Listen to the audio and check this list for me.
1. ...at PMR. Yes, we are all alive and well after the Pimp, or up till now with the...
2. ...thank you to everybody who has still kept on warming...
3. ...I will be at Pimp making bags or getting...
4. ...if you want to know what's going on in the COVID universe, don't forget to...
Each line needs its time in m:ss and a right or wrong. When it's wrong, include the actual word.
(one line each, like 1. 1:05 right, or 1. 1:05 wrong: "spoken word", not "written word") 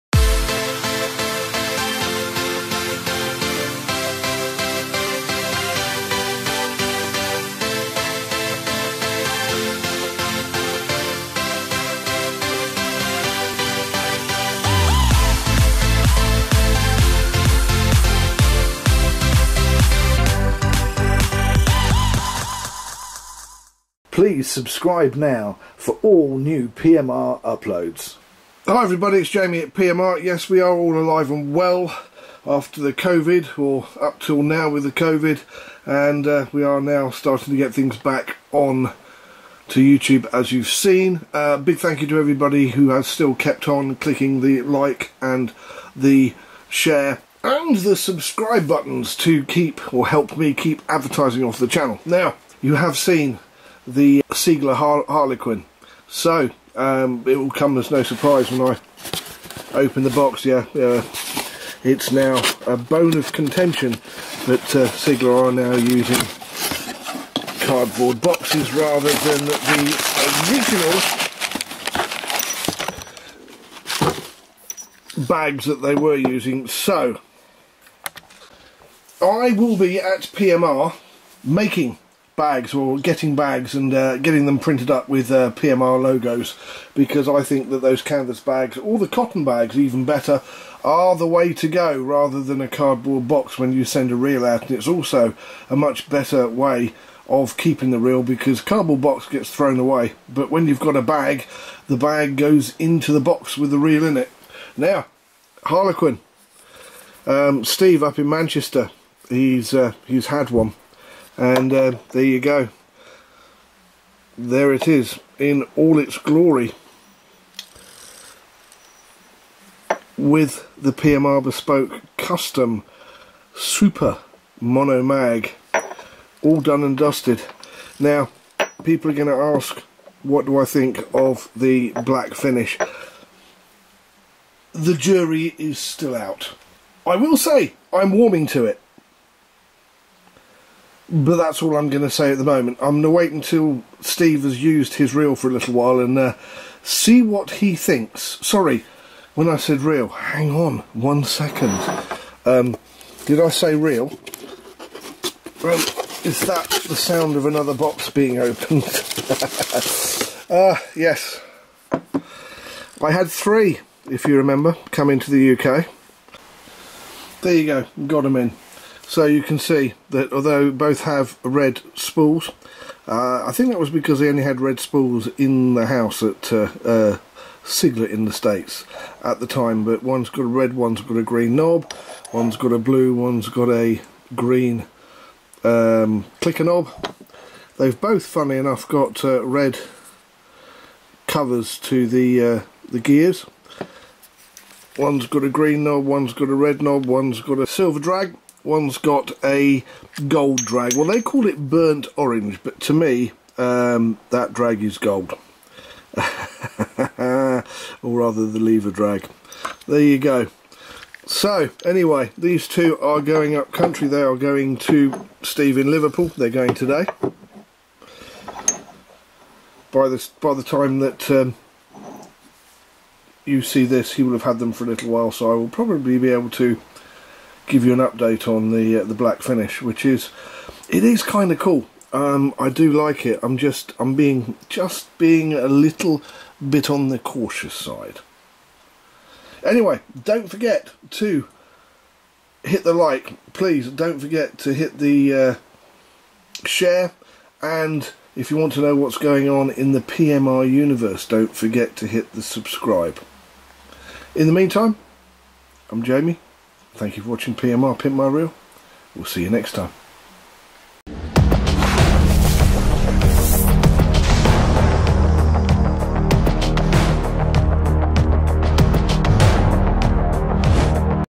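1. 0:29 wrong: "COVID", not "Pimp"
2. 0:41 wrong: "clicking", not "warming"
3. 1:19 wrong: "PMR", not "Pimp"
4. 4:08 wrong: "PMR", not "COVID".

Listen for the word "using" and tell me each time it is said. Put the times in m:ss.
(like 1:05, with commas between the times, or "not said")
1:05, 1:16.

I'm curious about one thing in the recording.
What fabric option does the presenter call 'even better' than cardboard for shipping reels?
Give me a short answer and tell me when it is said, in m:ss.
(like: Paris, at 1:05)
Cotton bags, at 1:29.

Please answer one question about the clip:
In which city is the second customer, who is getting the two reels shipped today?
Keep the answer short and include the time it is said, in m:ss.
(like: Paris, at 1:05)
Liverpool, at 3:35.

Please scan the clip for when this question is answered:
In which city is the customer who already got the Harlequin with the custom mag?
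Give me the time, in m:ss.
1:48.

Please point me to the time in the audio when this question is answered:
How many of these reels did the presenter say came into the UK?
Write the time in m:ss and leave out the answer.
2:43.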